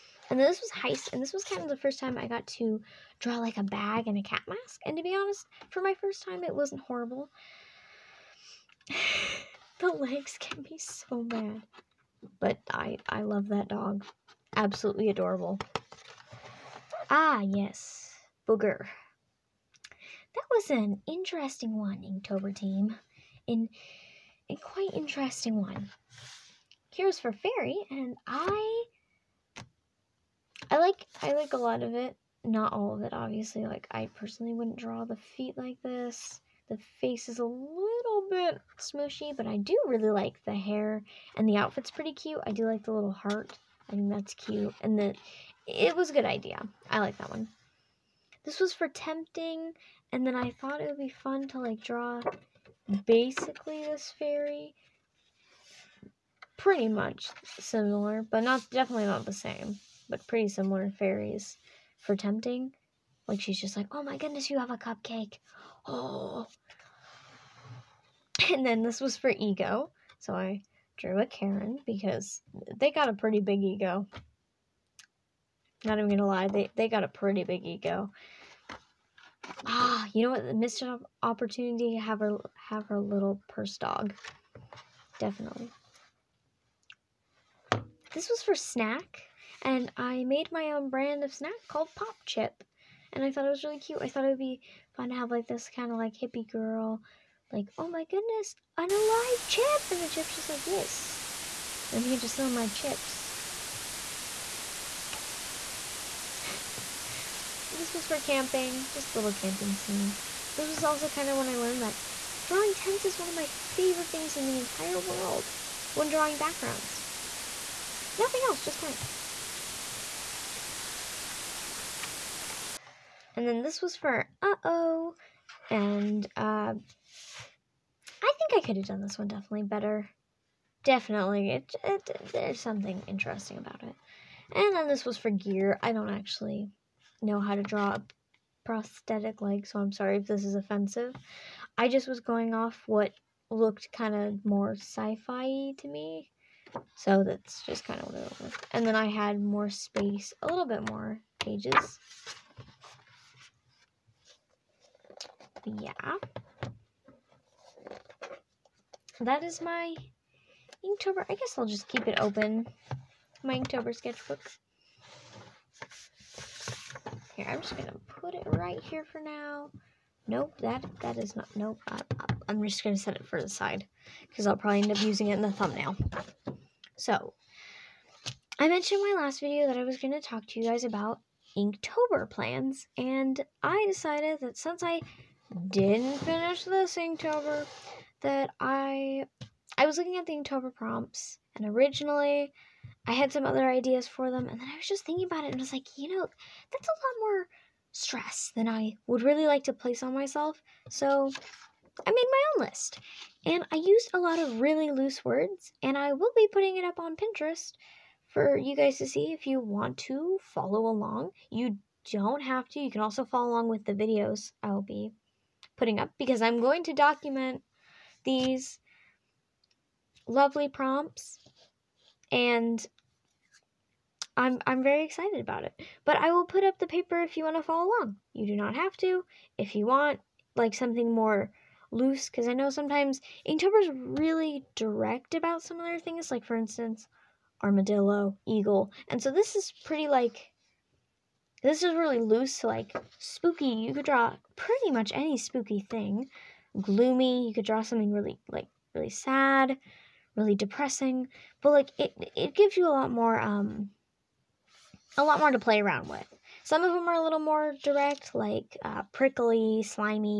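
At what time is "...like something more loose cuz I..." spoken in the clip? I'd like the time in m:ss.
3:50.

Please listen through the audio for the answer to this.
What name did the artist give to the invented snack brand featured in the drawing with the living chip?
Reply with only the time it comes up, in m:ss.
1:31.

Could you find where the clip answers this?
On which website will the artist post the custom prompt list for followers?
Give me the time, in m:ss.
3:27.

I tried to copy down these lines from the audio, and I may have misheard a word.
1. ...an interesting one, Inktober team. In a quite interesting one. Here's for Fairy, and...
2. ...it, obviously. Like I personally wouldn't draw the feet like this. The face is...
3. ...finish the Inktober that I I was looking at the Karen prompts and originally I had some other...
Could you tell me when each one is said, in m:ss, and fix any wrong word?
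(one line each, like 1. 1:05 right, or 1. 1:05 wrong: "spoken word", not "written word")
1. 0:20 right
2. 0:33 right
3. 3:06 wrong: "Inktober", not "Karen".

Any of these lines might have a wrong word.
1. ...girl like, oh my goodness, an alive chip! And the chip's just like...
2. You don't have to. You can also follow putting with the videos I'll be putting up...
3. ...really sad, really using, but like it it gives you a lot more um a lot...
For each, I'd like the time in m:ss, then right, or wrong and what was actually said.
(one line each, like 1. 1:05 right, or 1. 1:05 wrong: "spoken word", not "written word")
1. 1:36 right
2. 3:31 wrong: "along", not "putting"
3. 4:08 wrong: "depressing", not "using".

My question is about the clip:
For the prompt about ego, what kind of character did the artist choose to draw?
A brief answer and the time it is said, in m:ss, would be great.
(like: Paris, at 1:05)
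A Karen, at 1:11.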